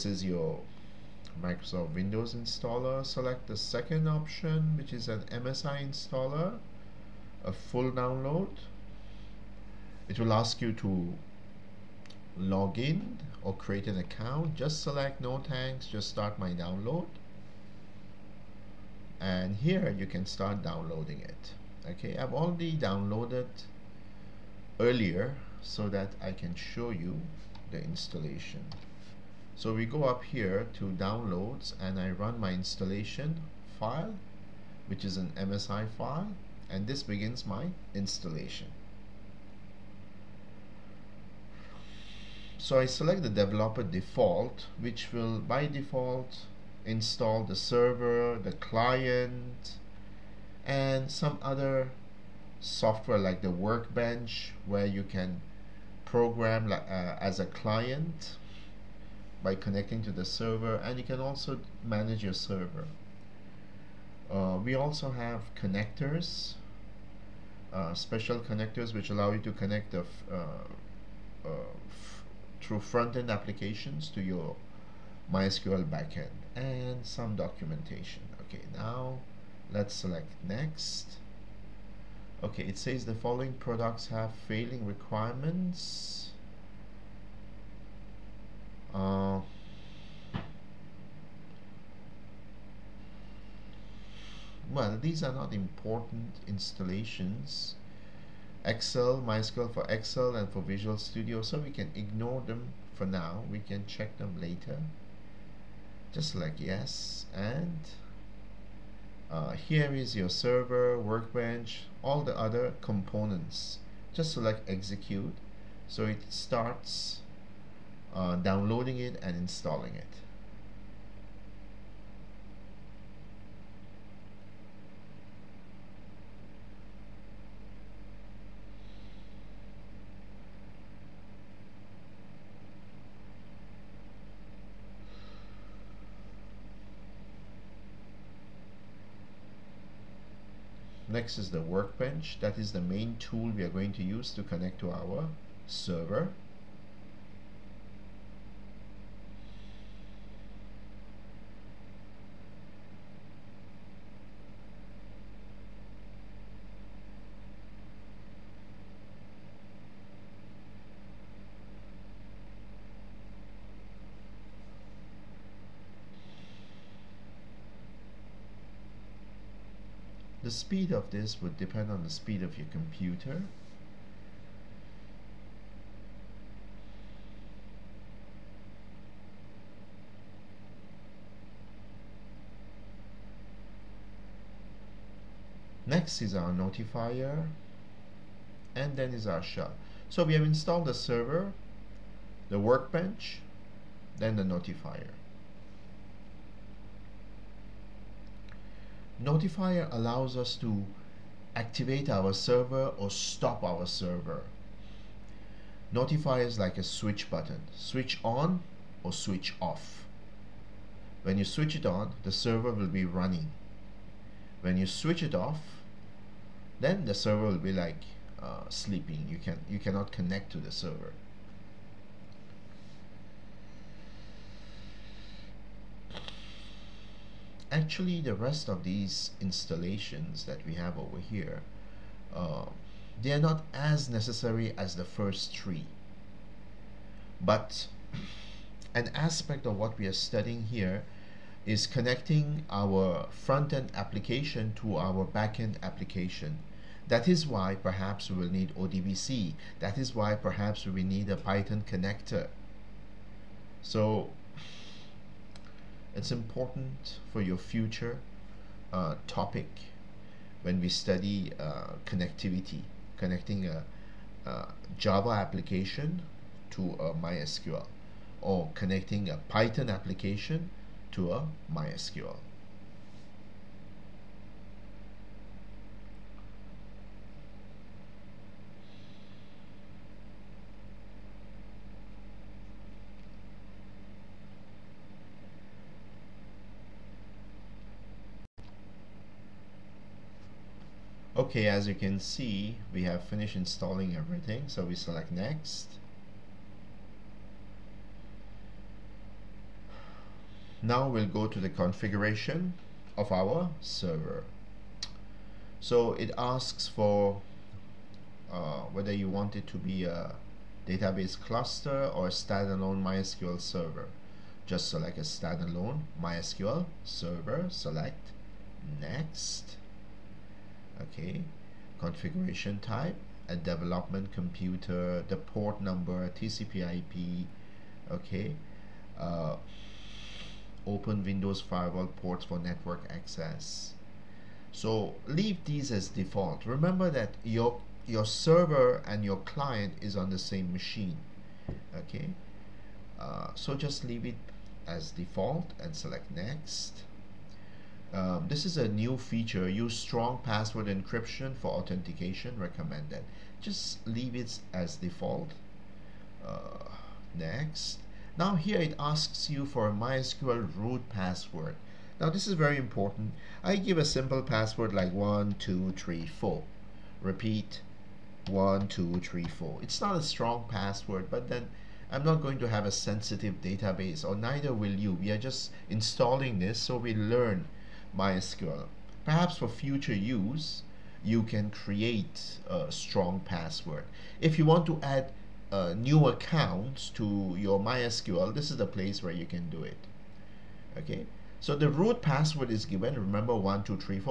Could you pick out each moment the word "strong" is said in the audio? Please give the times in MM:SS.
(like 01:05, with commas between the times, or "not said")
05:49, 06:10, 06:22.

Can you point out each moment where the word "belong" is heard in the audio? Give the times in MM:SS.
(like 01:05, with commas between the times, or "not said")
not said.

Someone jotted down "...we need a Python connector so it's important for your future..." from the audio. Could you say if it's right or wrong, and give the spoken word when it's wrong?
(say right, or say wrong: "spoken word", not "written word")
right.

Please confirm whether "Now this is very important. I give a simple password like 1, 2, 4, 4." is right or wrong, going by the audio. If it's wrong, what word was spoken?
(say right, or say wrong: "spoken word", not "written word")
wrong: "3", not "4".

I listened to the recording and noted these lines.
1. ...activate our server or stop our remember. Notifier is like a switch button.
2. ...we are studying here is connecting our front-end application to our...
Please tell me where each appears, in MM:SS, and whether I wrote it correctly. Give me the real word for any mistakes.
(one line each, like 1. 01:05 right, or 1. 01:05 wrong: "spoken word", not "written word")
1. 03:21 wrong: "server", not "remember"
2. 03:59 right.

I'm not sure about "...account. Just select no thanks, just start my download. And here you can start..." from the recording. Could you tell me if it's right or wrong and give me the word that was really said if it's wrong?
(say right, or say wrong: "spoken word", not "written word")
right.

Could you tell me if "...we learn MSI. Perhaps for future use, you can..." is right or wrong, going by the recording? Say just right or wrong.
wrong.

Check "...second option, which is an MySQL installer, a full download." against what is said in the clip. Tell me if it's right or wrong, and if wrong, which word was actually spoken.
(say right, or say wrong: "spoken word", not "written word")
wrong: "MSI", not "MySQL".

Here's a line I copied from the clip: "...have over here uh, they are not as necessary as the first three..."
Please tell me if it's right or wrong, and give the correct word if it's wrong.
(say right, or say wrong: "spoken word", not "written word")
right.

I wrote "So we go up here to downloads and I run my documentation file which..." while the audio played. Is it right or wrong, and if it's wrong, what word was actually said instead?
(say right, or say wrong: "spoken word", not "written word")
wrong: "installation", not "documentation".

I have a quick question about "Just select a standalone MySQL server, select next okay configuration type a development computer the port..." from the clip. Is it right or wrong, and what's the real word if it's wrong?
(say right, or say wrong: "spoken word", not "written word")
right.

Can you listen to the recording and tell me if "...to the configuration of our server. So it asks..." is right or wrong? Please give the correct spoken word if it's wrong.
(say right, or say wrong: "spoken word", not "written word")
right.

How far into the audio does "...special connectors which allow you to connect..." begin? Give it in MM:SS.
01:07.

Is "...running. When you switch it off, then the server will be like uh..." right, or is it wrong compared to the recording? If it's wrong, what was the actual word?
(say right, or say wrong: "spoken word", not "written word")
right.